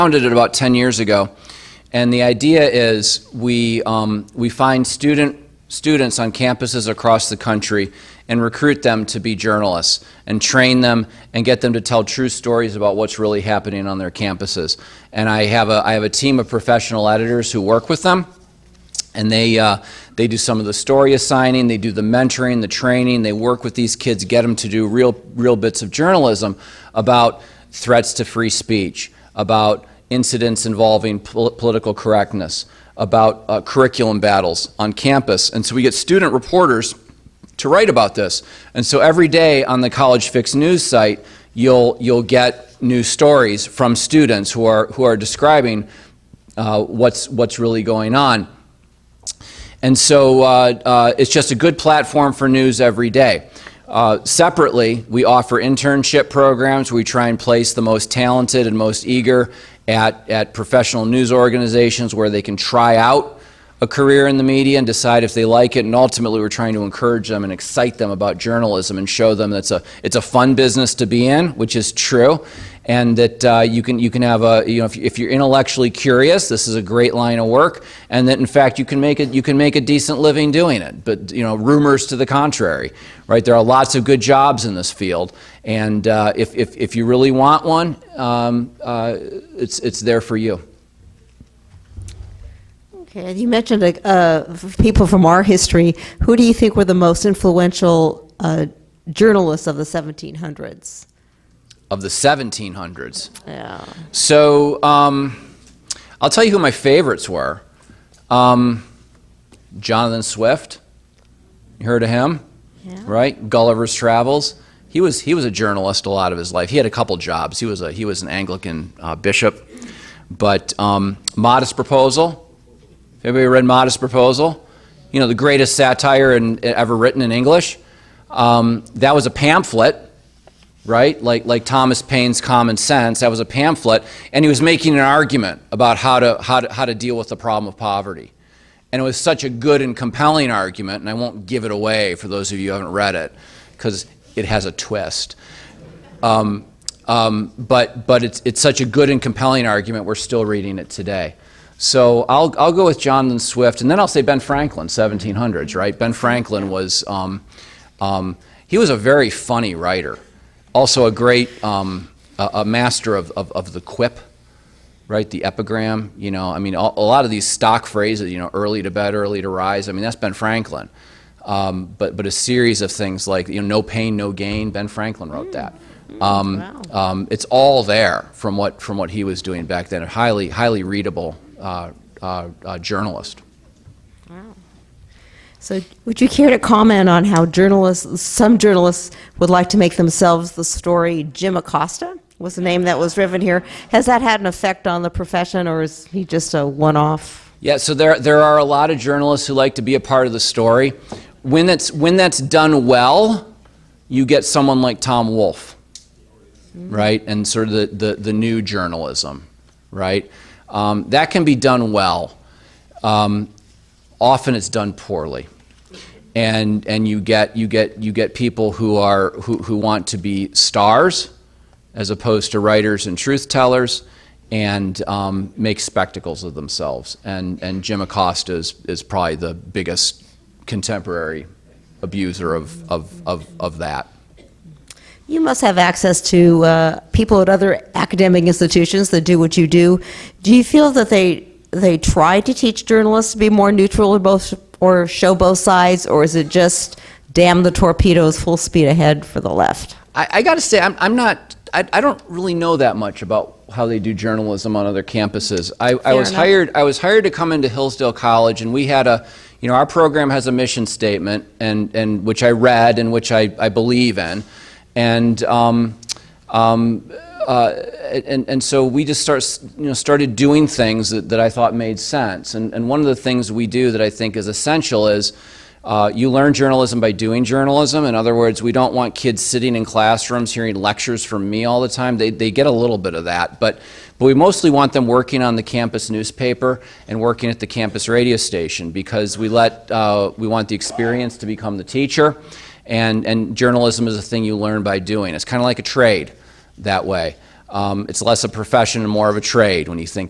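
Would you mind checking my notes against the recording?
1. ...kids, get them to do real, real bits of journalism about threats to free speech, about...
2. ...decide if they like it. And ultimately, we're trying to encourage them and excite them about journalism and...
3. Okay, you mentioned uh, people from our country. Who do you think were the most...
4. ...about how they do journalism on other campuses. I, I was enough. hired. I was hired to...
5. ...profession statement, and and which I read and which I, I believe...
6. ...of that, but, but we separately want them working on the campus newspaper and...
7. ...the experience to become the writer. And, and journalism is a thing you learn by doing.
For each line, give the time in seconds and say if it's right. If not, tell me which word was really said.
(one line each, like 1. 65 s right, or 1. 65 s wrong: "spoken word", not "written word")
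1. 23 s right
2. 64 s right
3. 92 s wrong: "history", not "country"
4. 253 s right
5. 260 s wrong: "mission", not "profession"
6. 283 s wrong: "mostly", not "separately"
7. 290 s wrong: "teacher", not "writer".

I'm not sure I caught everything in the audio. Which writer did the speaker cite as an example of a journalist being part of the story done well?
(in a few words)
Tom Wolfe.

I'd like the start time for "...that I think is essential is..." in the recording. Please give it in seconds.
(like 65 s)
273 s.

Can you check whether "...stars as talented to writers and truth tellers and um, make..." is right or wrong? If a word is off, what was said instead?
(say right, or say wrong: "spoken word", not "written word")
wrong: "opposed", not "talented".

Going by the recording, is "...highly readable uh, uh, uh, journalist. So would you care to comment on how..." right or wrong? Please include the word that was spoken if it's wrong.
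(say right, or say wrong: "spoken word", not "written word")
right.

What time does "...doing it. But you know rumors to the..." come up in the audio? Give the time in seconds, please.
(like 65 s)
80 s.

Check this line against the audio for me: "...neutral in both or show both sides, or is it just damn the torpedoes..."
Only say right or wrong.
right.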